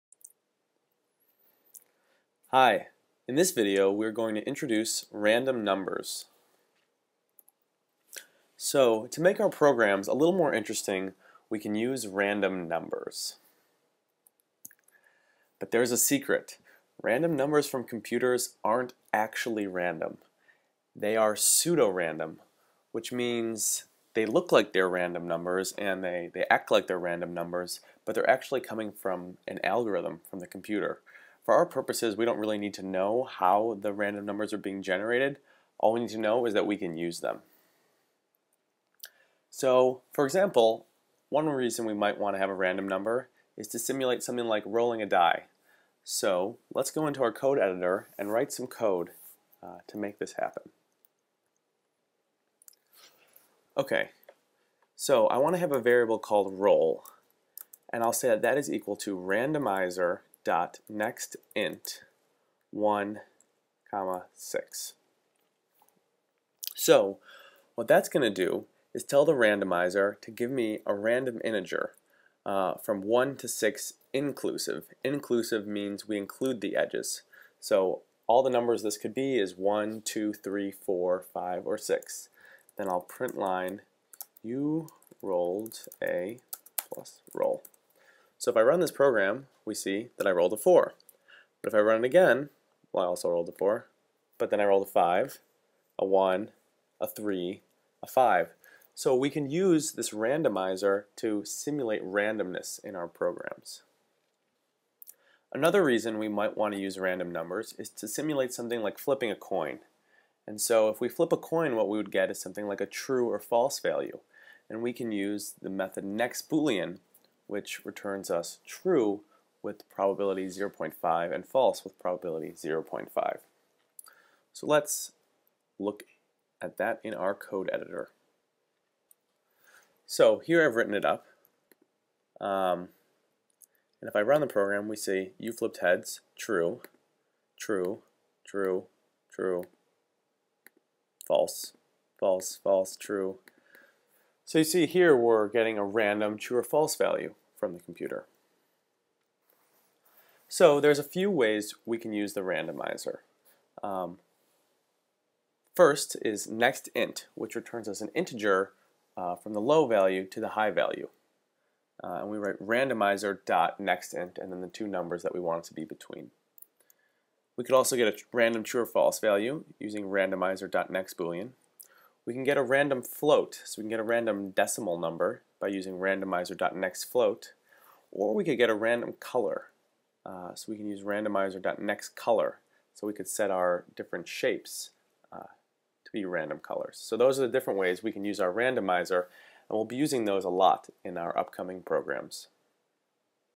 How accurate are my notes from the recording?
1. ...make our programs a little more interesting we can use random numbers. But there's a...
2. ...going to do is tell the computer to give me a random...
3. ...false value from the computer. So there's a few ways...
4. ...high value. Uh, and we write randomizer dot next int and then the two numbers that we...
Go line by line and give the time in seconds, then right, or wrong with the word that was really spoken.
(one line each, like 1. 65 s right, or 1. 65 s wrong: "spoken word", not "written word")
1. 9 s right
2. 68 s wrong: "randomizer", not "computer"
3. 146 s right
4. 160 s right.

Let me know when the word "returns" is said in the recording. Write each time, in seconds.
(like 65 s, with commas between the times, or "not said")
117 s, 157 s.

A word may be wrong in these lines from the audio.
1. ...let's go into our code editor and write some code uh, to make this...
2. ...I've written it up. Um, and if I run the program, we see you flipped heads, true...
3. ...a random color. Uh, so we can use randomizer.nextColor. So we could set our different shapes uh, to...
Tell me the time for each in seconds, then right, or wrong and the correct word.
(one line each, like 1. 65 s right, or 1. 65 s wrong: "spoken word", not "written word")
1. 46 s right
2. 130 s right
3. 178 s right.